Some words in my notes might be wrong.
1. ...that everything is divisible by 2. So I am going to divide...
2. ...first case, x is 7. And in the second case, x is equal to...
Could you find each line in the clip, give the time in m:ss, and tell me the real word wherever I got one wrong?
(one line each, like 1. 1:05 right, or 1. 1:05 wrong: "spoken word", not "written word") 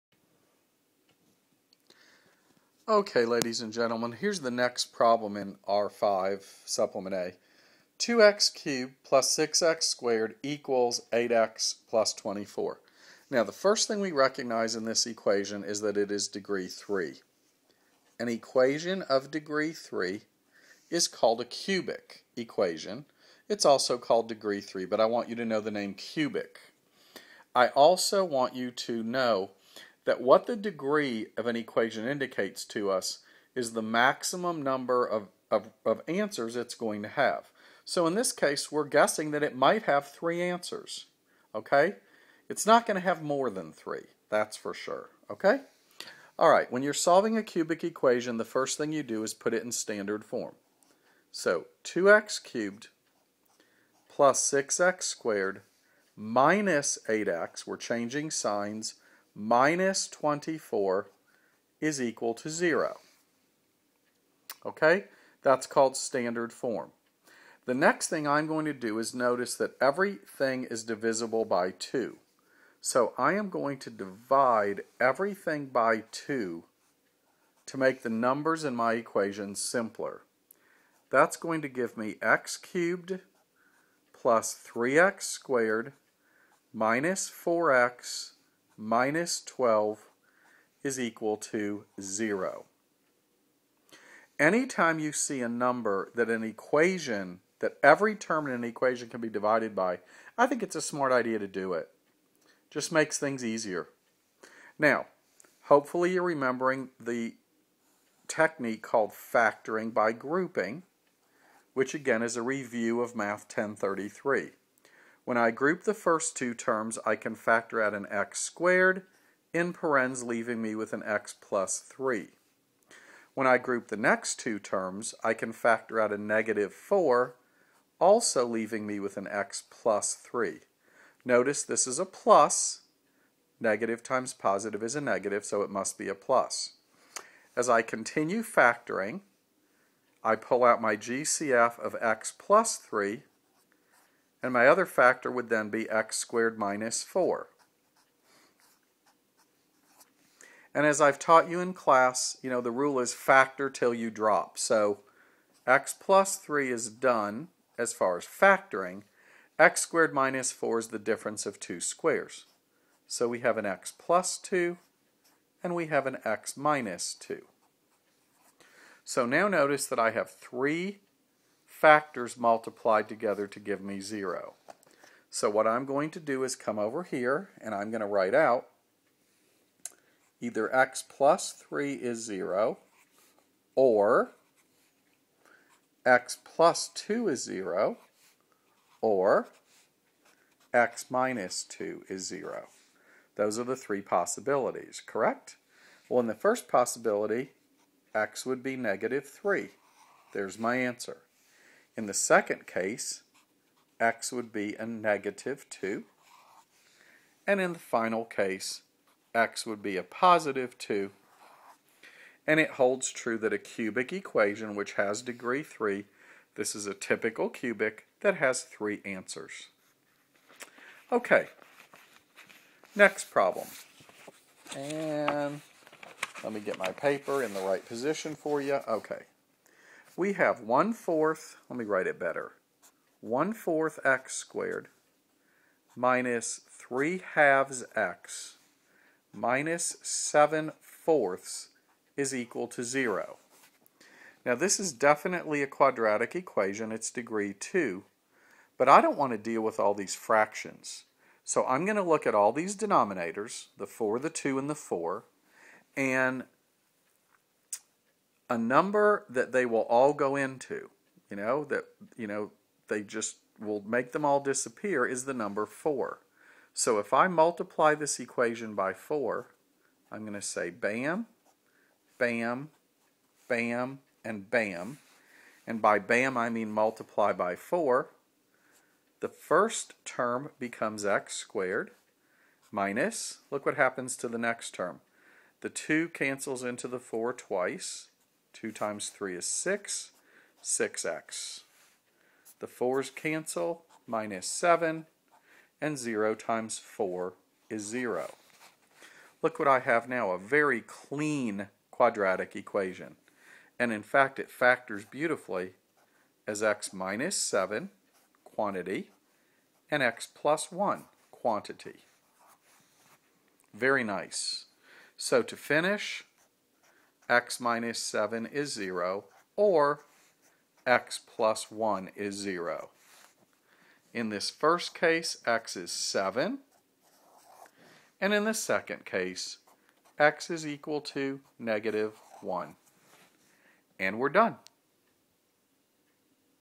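1. 1:09 right
2. 5:24 right.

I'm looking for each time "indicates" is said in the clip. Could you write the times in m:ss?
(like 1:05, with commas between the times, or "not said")
0:32.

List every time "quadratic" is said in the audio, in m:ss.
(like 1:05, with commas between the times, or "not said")
4:05, 5:01.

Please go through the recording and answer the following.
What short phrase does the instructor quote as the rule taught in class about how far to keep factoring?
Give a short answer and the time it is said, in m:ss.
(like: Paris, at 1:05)
factor till you drop, at 2:33.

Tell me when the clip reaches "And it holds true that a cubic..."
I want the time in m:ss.
3:32.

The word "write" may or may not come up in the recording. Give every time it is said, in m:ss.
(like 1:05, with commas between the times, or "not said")
2:58, 3:51.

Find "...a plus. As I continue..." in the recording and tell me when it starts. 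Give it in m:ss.
2:16.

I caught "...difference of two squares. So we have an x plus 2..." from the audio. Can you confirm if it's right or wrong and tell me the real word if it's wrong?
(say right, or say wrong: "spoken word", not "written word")
right.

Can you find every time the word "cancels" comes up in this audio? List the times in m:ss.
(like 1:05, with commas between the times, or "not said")
4:46, 4:53.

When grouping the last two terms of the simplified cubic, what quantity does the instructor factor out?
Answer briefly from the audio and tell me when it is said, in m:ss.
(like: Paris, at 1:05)
-4, at 2:06.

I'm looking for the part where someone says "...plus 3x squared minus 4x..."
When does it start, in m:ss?
1:24.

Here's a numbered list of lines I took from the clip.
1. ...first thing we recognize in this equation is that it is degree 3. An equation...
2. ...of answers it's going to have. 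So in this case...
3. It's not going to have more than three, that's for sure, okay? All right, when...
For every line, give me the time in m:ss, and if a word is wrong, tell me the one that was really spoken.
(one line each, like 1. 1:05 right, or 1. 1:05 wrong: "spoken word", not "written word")
1. 0:13 right
2. 0:35 right
3. 0:42 right.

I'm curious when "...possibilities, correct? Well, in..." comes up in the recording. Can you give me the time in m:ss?
3:14.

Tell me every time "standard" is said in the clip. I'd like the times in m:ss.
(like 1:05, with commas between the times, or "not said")
0:49, 1:05.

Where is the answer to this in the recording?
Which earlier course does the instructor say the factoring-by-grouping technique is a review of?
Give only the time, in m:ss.
1:53.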